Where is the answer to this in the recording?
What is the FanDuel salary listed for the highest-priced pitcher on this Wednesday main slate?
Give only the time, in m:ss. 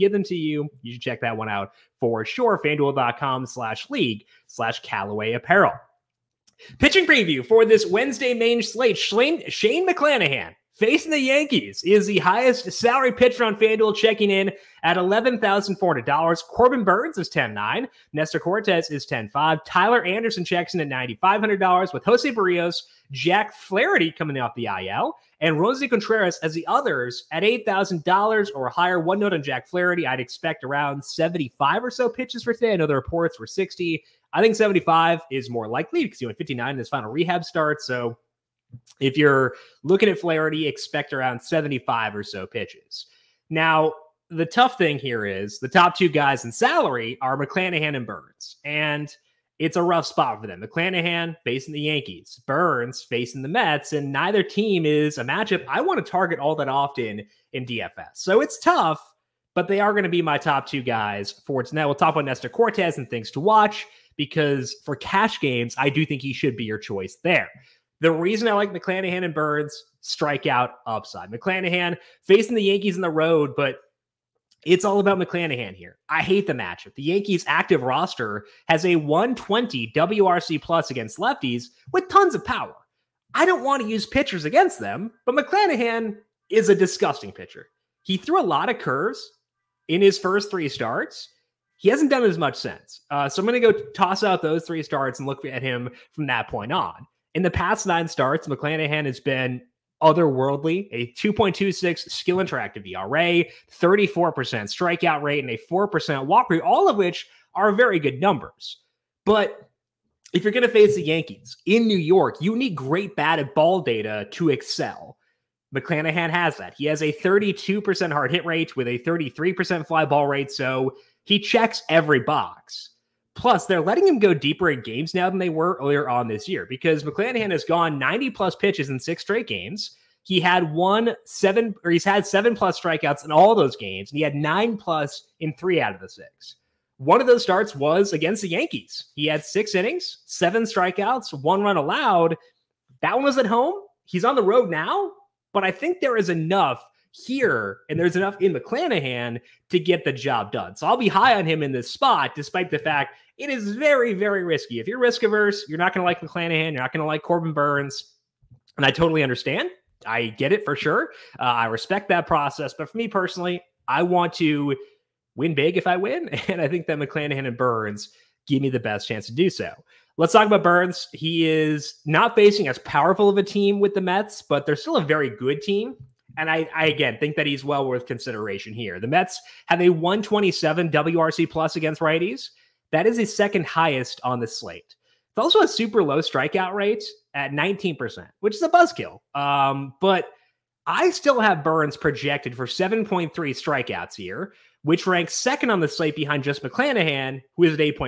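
0:14.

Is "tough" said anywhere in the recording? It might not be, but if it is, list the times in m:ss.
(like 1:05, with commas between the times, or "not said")
0:44, 0:58.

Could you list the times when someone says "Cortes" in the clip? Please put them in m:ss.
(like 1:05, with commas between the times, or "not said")
0:18, 1:02.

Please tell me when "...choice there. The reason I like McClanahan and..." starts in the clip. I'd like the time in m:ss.
1:06.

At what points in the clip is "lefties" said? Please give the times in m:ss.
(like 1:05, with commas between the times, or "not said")
1:21.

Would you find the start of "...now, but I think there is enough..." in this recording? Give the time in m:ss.
2:24.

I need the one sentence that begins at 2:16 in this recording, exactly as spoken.
One of those starts was against the Yankees.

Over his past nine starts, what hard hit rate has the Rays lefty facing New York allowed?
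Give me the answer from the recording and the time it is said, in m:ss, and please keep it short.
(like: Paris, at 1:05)
32%, at 1:57.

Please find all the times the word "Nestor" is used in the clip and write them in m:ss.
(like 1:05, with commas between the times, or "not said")
0:18, 1:02.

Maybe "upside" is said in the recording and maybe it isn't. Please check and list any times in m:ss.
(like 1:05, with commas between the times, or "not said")
1:10.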